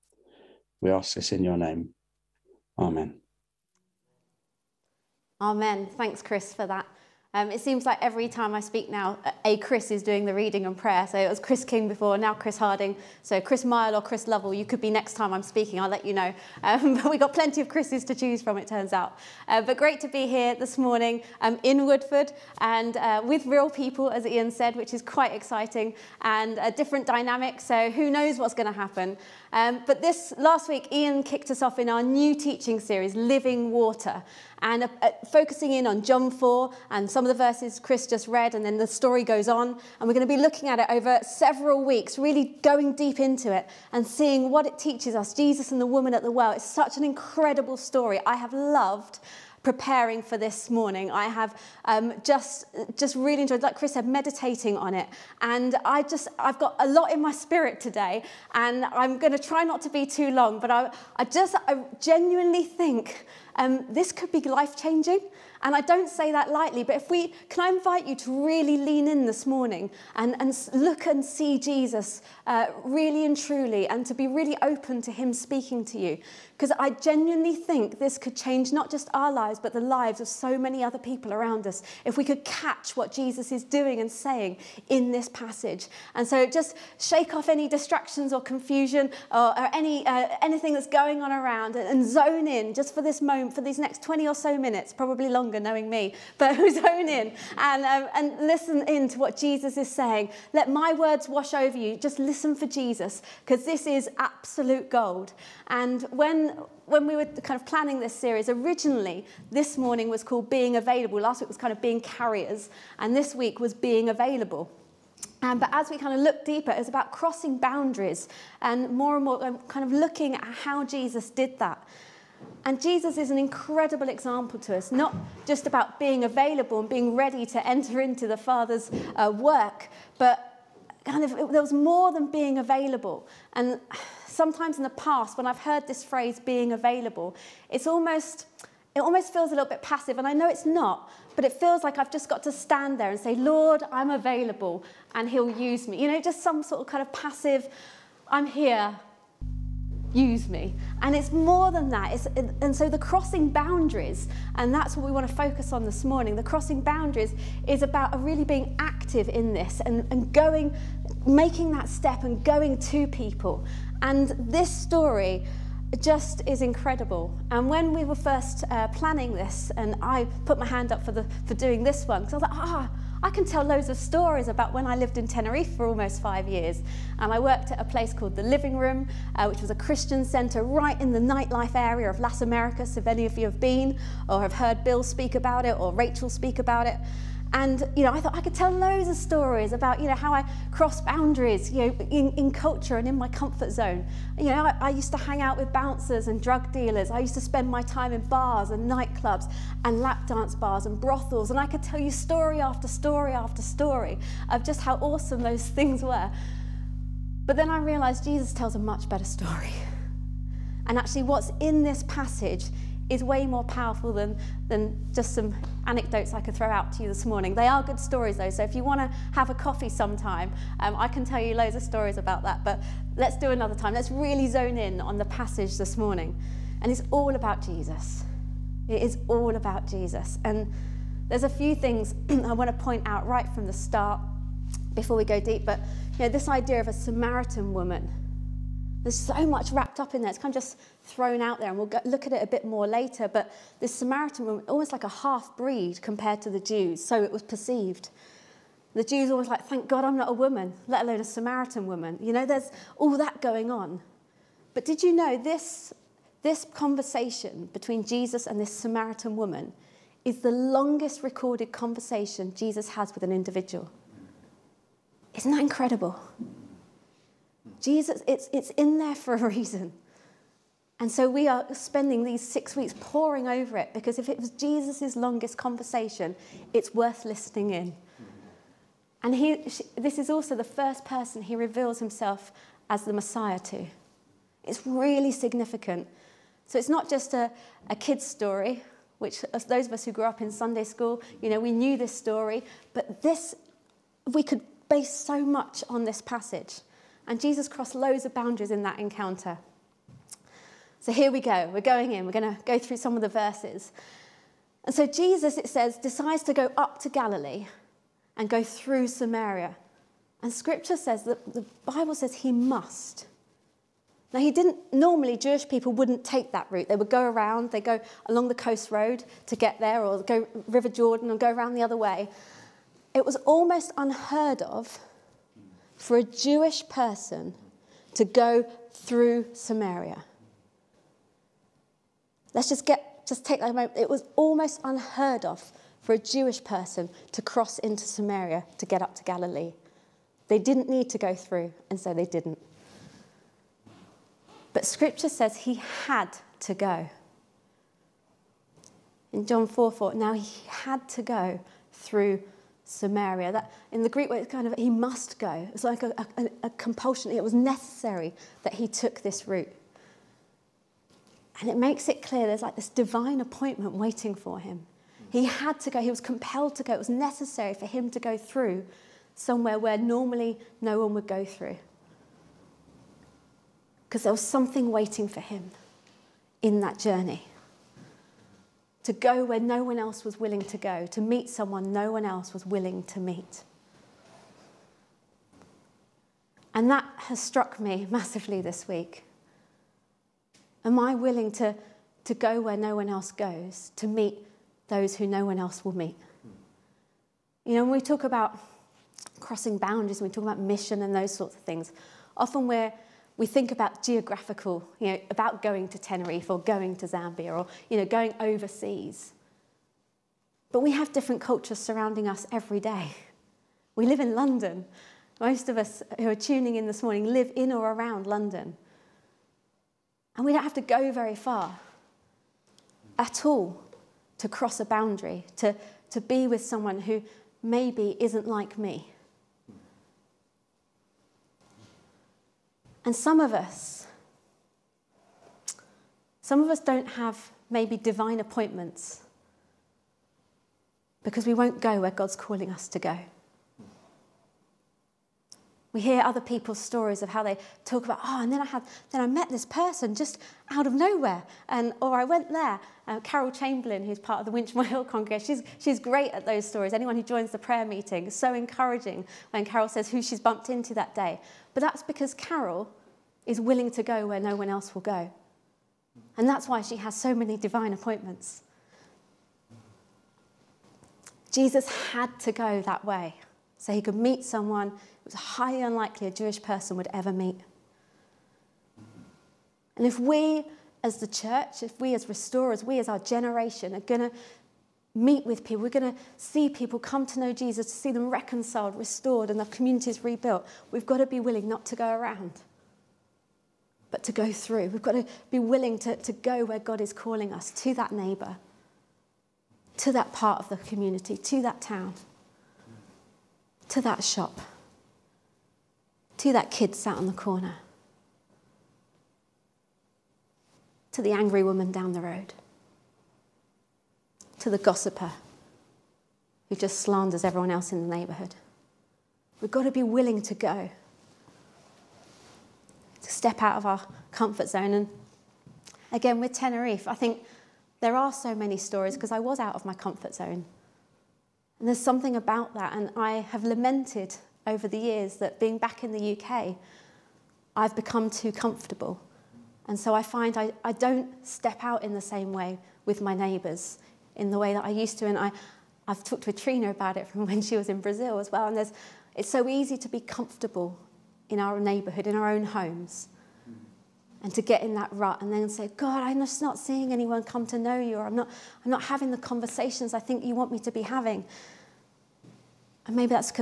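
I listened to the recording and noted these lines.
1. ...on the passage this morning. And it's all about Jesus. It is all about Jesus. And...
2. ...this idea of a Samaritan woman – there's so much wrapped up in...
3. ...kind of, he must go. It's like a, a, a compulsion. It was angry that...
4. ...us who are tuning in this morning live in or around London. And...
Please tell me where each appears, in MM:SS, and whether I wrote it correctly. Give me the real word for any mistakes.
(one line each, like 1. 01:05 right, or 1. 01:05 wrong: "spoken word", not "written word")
1. 03:45 right
2. 03:56 right
3. 05:54 wrong: "necessary", not "angry"
4. 06:55 right.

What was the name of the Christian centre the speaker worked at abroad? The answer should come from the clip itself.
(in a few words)
The Living Room.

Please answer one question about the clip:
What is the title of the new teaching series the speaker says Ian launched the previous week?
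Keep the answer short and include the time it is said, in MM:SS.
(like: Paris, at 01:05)
Living Water, at 00:33.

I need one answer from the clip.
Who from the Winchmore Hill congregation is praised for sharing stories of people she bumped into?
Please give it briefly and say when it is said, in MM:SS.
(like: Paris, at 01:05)
Carol Chamberlain, at 07:33.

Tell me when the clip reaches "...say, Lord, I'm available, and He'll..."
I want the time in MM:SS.
02:23.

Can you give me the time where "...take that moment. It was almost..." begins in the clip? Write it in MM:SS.
05:33.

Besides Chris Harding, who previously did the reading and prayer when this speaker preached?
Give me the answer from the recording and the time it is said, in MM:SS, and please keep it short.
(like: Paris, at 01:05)
Chris King, at 00:11.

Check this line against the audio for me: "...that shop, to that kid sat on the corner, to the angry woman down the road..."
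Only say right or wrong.
right.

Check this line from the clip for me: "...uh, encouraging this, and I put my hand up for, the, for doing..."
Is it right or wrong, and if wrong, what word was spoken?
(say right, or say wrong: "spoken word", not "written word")
wrong: "planning", not "encouraging".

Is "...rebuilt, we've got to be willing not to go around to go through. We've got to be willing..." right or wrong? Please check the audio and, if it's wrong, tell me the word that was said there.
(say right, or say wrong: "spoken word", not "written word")
right.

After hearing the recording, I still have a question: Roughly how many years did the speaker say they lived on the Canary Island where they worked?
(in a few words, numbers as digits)
5.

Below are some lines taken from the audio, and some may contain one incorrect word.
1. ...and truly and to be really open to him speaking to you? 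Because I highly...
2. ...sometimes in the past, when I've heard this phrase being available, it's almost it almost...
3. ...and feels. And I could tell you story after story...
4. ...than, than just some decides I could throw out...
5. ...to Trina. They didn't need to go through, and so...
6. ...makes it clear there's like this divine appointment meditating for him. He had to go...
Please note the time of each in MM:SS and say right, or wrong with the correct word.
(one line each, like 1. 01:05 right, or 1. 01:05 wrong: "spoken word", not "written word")
1. 01:13 wrong: "genuinely", not "highly"
2. 02:14 right
3. 03:20 wrong: "brothels", not "feels"
4. 03:34 wrong: "anecdotes", not "decides"
5. 05:39 wrong: "Galilee", not "Trina"
6. 06:01 wrong: "waiting", not "meditating".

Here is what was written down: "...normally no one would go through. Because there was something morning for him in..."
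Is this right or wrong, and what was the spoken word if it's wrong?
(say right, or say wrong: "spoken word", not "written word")
wrong: "waiting", not "morning".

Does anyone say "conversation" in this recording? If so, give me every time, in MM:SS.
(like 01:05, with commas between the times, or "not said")
04:16, 04:21, 04:35, 09:19.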